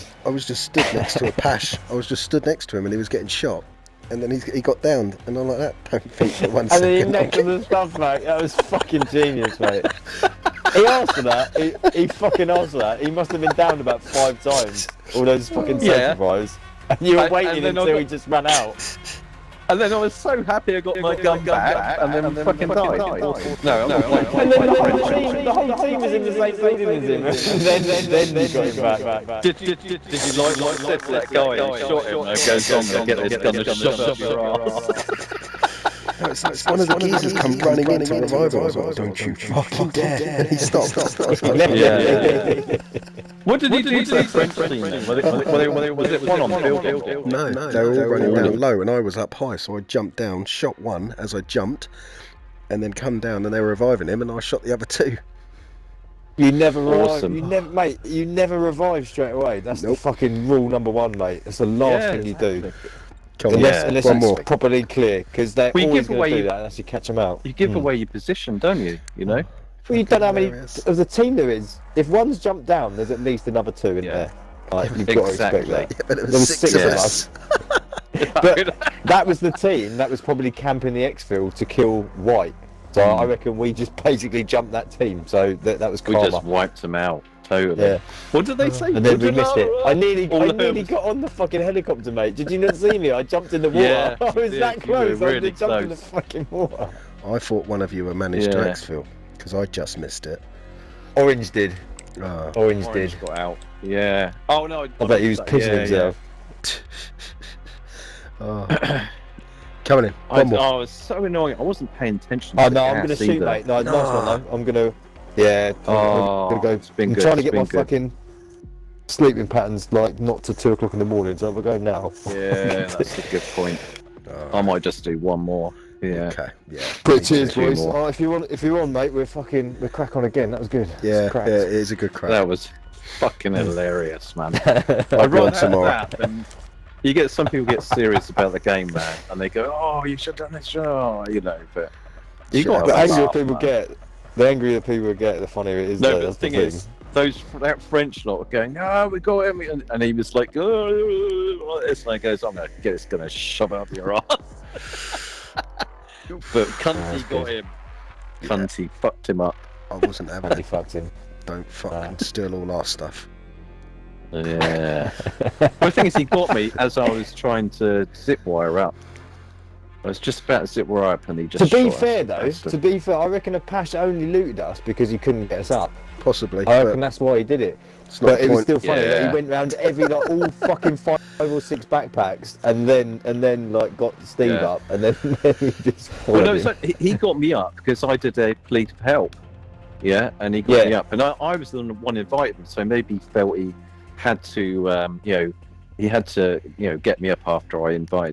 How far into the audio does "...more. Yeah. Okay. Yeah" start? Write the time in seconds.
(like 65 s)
125 s.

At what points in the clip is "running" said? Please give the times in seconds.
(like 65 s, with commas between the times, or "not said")
37 s, 48 s.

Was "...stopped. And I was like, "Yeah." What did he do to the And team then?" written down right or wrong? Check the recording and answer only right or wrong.
wrong.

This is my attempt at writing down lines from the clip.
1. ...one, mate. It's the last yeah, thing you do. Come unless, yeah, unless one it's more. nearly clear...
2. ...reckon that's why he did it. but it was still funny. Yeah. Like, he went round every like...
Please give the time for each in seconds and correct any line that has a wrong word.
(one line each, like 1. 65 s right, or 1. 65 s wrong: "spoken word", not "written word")
1. 60 s wrong: "properly", not "nearly"
2. 176 s right.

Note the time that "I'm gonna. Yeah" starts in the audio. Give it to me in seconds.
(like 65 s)
114 s.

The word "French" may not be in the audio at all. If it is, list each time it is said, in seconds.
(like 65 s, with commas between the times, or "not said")
24 s, 44 s, 147 s.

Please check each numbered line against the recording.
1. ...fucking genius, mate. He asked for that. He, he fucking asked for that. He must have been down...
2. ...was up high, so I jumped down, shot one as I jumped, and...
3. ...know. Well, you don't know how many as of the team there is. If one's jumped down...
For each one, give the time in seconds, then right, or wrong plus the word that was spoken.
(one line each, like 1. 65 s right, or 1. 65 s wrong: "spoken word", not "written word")
1. 8 s right
2. 48 s right
3. 69 s right.